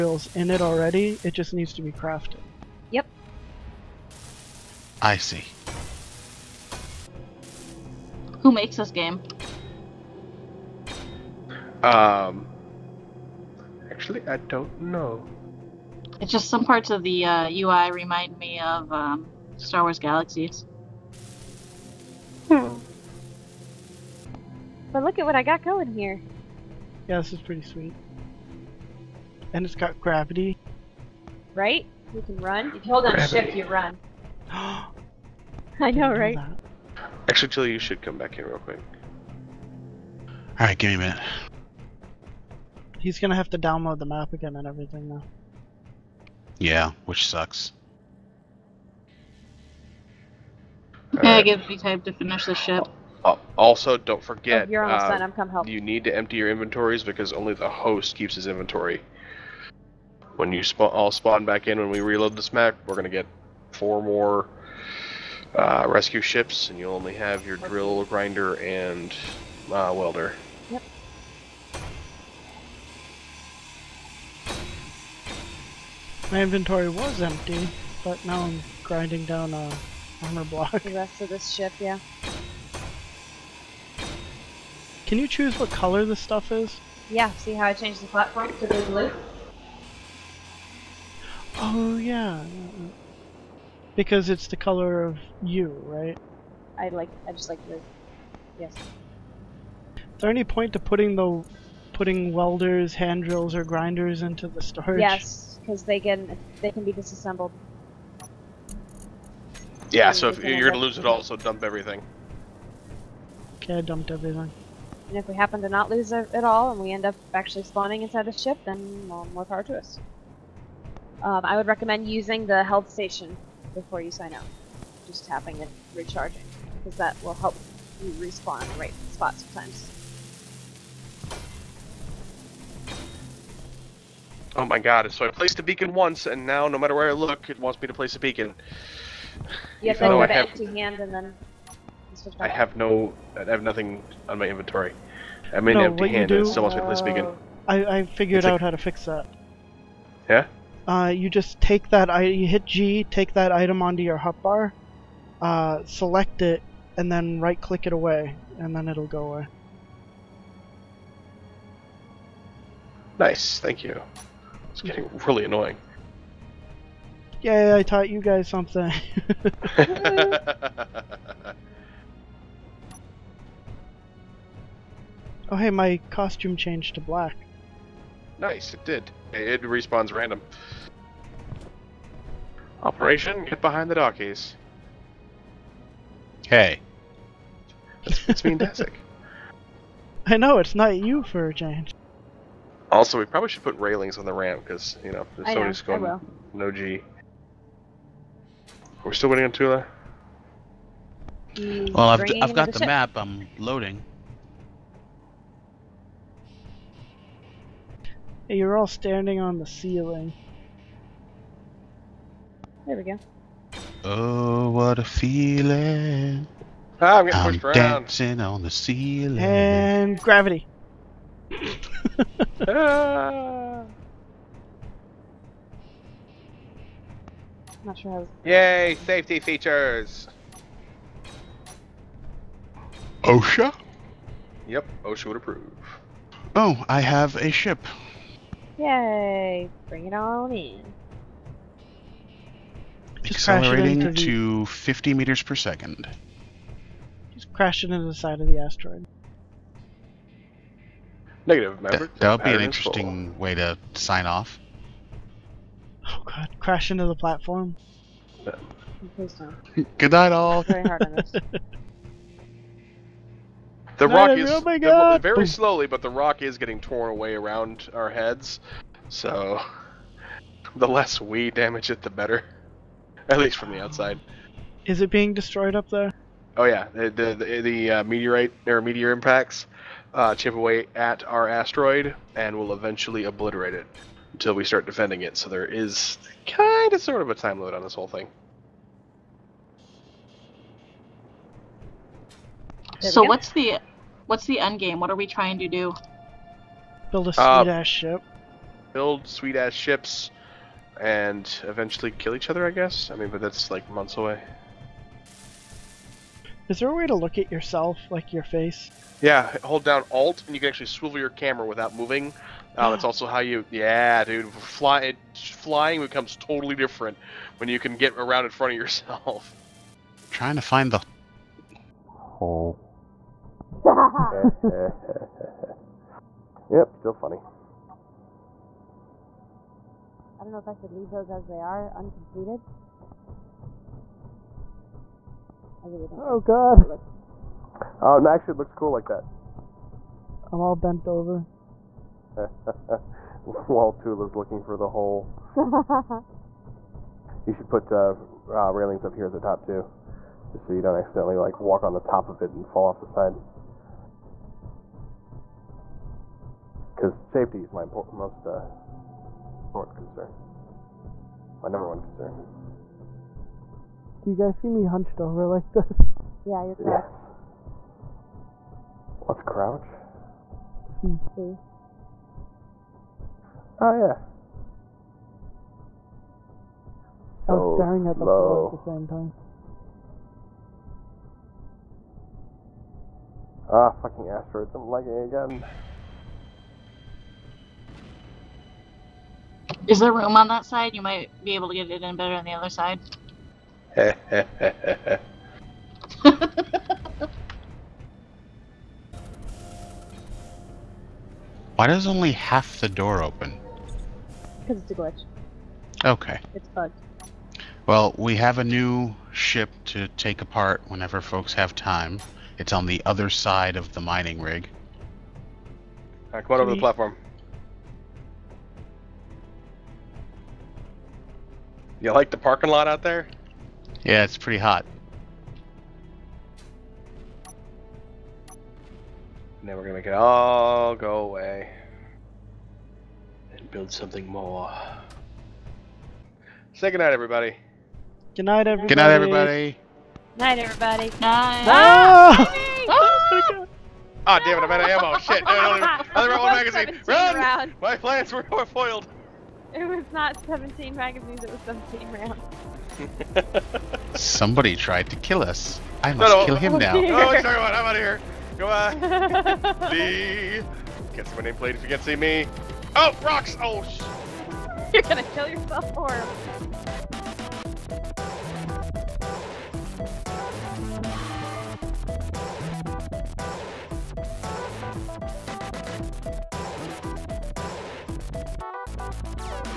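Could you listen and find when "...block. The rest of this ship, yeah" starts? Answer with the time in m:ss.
1:20.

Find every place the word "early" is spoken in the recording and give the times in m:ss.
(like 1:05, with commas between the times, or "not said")
not said.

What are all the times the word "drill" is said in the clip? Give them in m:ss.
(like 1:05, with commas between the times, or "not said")
1:07, 1:43.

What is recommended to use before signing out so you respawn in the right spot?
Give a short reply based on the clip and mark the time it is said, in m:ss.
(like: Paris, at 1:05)
health station, at 2:02.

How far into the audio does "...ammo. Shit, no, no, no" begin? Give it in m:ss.
7:24.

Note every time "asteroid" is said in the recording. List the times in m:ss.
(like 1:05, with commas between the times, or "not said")
4:08, 4:41, 6:24.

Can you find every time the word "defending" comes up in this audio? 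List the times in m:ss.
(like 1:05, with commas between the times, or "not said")
4:44.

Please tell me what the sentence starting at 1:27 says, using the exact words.
Yeah, see how I changed the platform to the blue?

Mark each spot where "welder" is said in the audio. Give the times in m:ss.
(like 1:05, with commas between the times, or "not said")
1:09, 1:42.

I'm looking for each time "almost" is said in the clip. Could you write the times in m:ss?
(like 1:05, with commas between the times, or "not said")
0:54, 2:26.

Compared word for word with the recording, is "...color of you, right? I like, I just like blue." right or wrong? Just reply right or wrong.
right.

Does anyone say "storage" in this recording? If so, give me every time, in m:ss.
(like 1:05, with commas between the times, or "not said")
1:44.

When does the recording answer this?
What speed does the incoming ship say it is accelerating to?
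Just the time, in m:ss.
4:04.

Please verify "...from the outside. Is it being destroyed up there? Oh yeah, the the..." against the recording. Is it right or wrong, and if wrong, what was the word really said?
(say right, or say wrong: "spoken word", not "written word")
right.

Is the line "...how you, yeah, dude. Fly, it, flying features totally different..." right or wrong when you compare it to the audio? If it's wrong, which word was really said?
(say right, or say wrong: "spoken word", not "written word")
wrong: "becomes", not "features".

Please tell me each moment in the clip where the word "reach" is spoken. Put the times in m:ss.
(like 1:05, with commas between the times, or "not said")
not said.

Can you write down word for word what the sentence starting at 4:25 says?
The, very slowly, but the rock is getting torn away around our heads.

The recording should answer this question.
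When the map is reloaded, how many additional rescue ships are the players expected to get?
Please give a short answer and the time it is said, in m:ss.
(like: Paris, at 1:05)
4, at 1:03.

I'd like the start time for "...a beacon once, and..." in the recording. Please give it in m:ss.
2:15.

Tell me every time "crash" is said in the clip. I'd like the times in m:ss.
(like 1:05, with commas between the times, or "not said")
4:07, 4:16.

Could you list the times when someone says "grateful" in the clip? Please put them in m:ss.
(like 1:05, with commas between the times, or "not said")
not said.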